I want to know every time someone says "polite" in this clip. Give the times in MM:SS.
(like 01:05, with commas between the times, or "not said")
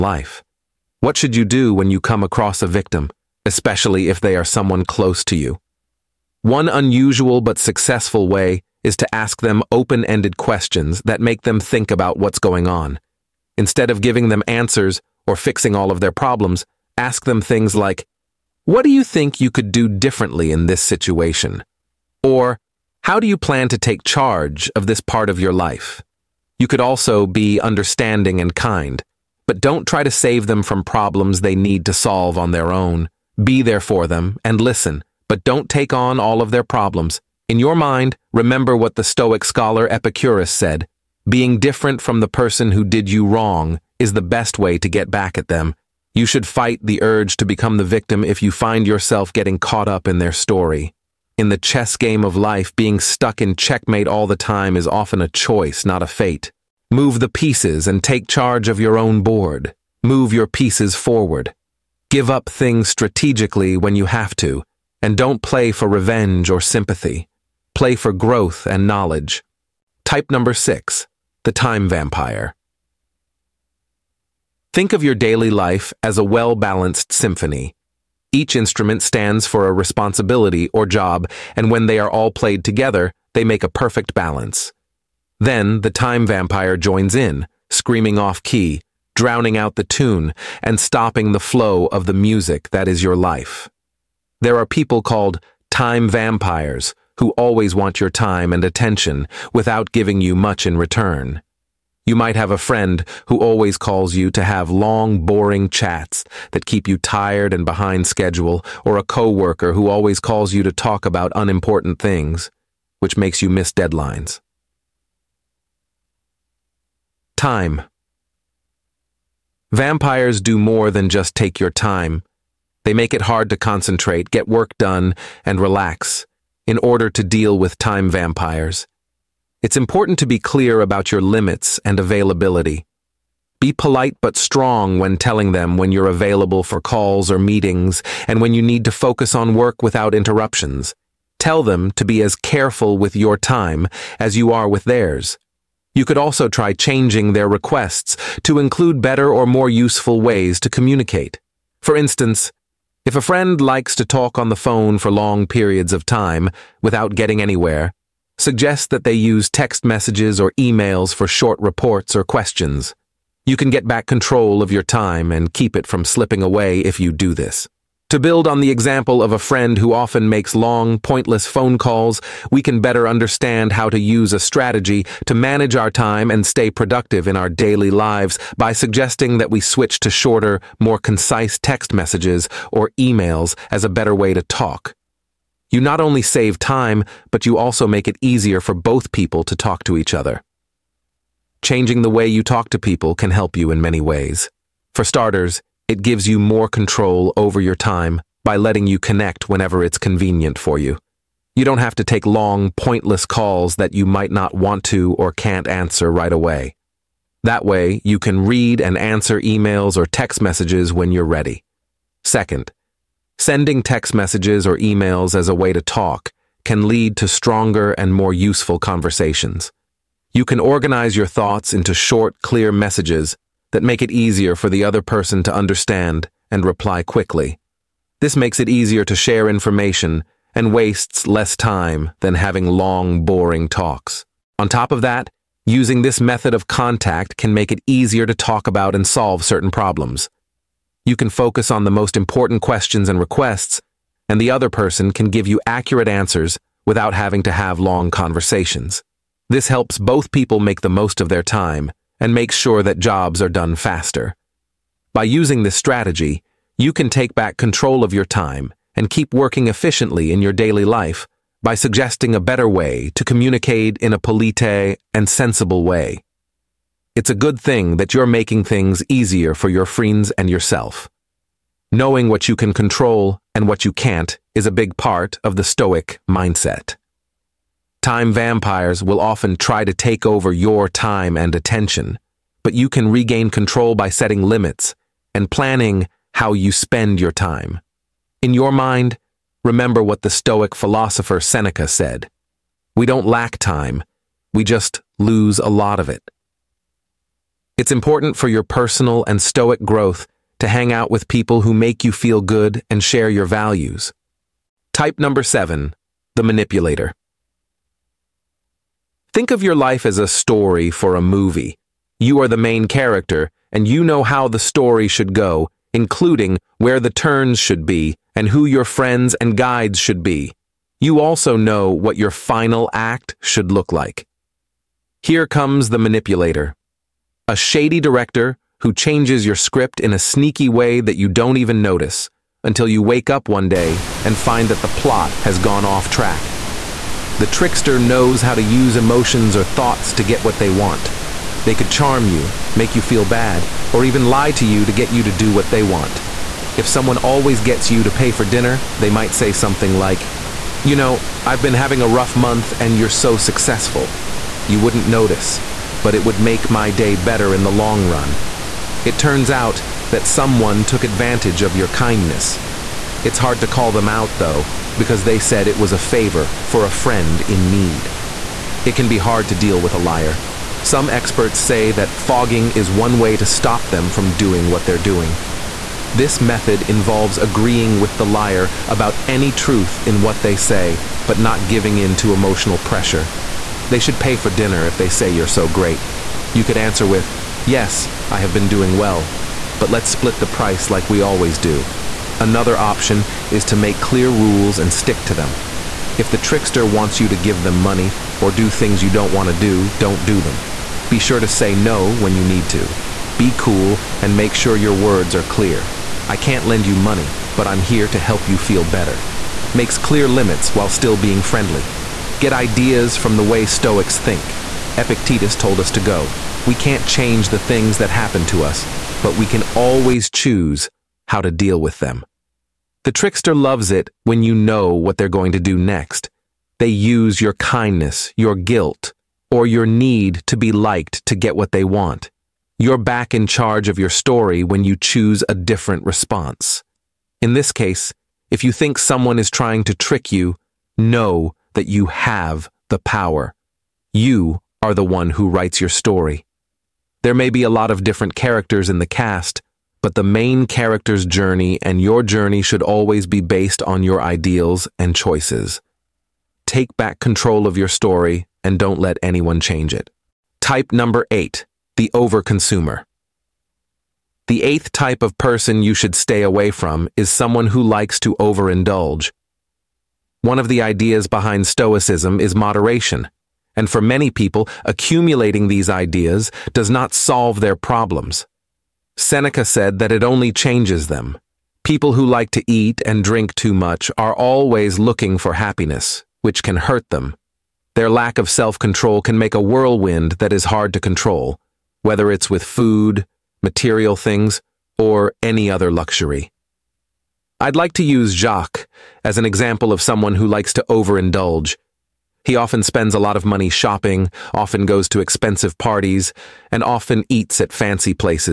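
02:13, 04:24.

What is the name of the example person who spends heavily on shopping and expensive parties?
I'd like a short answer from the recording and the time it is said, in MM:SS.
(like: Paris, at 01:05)
Jacques, at 08:18.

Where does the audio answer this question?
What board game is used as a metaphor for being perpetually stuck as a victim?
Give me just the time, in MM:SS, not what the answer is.
00:51.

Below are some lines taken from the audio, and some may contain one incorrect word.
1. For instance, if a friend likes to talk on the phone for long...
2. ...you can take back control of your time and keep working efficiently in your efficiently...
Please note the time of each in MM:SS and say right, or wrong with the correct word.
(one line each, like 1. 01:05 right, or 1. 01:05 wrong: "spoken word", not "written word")
1. 02:31 right
2. 04:16 wrong: "daily", not "efficiently".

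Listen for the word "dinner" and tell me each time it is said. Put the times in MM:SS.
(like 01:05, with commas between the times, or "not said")
05:48, 06:24.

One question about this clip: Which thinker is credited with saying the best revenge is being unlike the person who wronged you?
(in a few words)
Epicurus.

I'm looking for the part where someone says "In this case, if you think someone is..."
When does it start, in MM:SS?
07:17.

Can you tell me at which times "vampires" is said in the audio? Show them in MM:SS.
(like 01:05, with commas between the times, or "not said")
01:11, 01:26, 01:36, 01:59, 02:08, 04:38.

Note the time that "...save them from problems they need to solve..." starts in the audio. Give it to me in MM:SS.
00:30.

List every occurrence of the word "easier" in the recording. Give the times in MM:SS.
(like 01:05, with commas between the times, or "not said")
03:08, 03:44, 03:48, 03:57, 04:29.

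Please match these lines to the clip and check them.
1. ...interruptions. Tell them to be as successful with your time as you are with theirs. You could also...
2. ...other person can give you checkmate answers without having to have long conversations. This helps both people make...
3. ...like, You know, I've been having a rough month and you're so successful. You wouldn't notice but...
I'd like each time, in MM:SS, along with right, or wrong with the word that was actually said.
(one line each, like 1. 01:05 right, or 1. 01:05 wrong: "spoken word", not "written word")
1. 02:20 wrong: "careful", not "successful"
2. 04:04 wrong: "accurate", not "checkmate"
3. 05:49 right.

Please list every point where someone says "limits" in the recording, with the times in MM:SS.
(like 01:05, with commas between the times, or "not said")
02:11, 04:44, 06:50.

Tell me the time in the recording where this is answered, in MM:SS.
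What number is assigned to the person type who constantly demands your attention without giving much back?
01:10.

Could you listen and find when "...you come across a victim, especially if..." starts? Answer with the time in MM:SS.
00:01.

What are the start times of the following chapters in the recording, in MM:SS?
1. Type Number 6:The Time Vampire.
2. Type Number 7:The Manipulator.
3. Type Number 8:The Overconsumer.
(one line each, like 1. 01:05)
1. 01:09
2. 05:04
3. 07:39.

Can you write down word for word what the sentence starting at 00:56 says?
Move the pieces and take charge of your own board.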